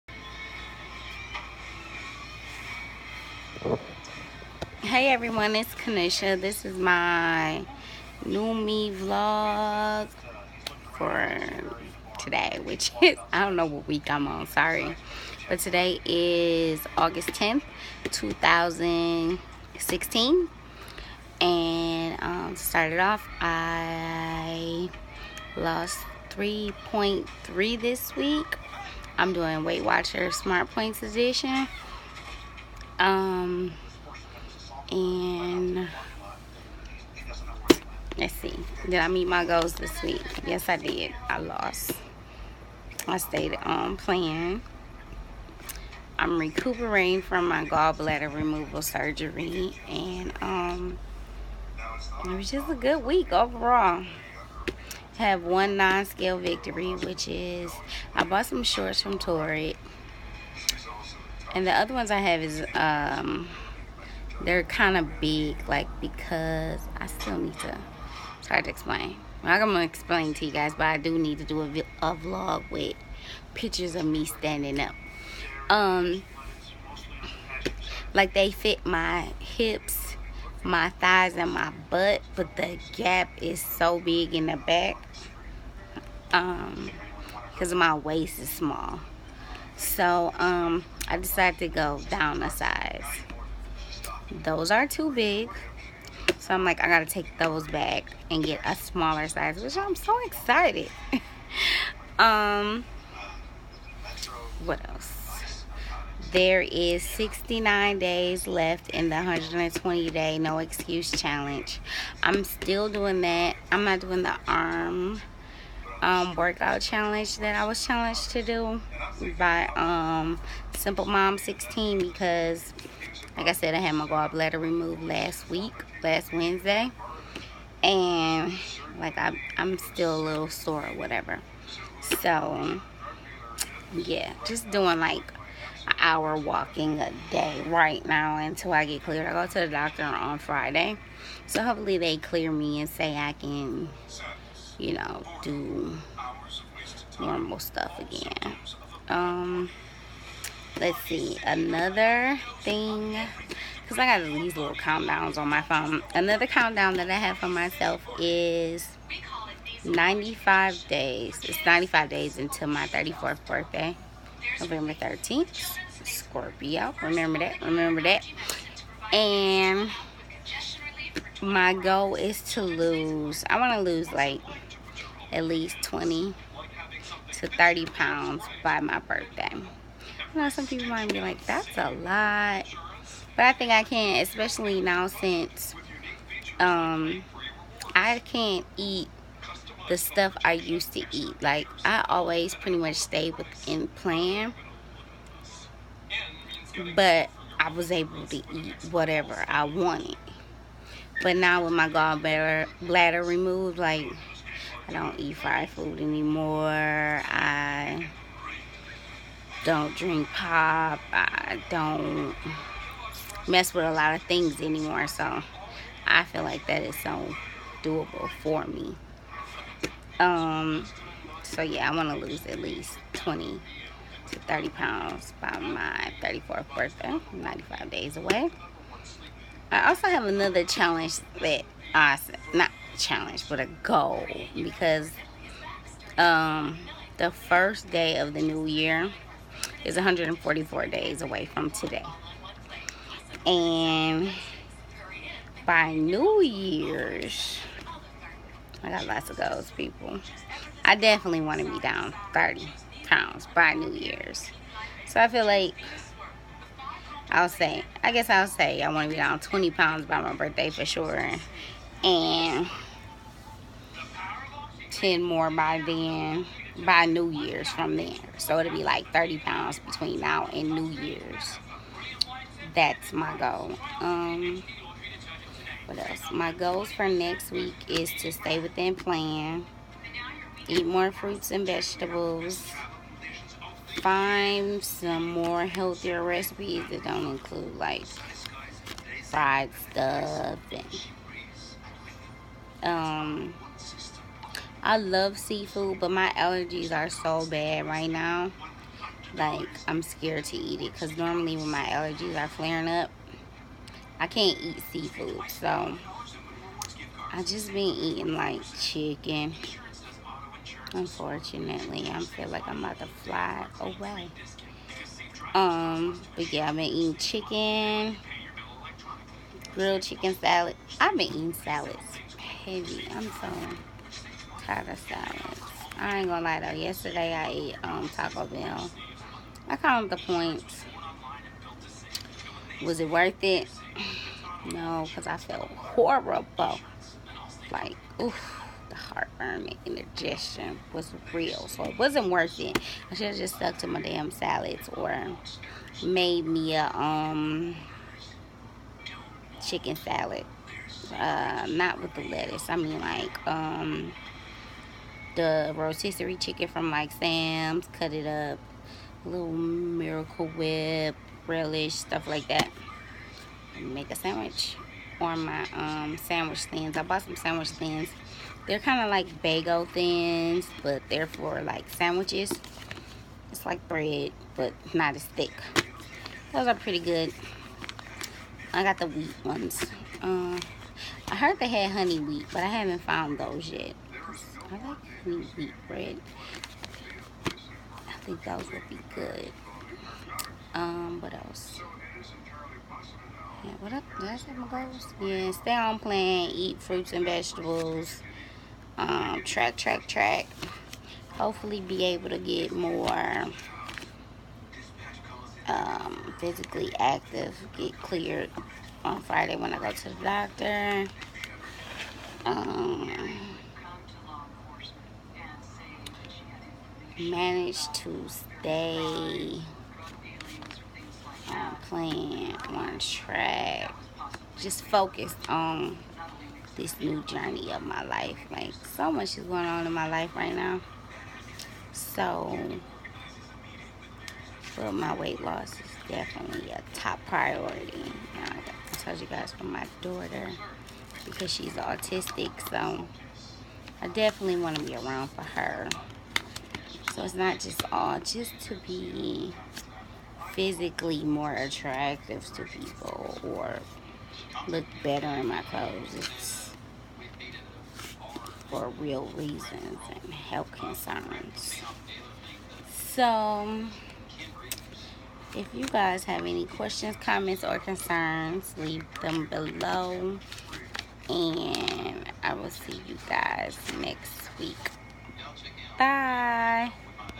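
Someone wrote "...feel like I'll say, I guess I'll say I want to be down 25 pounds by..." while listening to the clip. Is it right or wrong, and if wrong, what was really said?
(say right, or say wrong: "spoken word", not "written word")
wrong: "20", not "25".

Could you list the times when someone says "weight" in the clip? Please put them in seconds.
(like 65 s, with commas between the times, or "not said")
29 s, 435 s.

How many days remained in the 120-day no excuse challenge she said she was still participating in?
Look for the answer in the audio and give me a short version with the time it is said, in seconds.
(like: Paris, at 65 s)
69, at 107 s.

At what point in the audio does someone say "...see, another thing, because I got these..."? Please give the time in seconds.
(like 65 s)
151 s.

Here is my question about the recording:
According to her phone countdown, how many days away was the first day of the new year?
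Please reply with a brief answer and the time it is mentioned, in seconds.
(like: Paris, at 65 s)
144, at 239 s.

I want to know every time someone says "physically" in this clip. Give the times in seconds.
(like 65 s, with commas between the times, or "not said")
406 s, 450 s.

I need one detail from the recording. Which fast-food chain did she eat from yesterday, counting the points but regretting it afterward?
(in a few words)
Taco Bell.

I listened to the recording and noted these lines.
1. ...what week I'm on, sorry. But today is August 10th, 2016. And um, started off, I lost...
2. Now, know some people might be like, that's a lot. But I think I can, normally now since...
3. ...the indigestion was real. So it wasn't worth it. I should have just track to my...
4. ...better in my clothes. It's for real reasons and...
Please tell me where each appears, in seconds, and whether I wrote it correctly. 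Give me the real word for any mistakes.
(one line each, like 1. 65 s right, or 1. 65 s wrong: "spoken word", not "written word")
1. 13 s right
2. 180 s wrong: "especially", not "normally"
3. 339 s wrong: "stuck", not "track"
4. 455 s right.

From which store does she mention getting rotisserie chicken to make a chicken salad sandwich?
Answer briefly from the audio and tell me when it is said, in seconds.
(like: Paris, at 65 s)
Sam's, at 357 s.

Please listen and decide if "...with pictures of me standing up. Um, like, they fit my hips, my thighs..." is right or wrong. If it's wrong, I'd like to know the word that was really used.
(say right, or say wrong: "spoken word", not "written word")
right.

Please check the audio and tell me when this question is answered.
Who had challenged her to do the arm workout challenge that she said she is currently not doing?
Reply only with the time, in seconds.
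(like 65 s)
120 s.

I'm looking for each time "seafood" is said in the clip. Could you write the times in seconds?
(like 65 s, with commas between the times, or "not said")
295 s, 304 s.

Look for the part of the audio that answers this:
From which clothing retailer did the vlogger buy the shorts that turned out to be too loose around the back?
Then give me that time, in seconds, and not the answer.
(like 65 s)
59 s.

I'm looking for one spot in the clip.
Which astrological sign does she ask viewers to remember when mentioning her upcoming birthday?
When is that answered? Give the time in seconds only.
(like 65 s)
166 s.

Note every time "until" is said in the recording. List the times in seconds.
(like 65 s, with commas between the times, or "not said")
138 s, 162 s.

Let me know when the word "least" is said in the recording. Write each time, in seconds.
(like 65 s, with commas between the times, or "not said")
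175 s, 222 s.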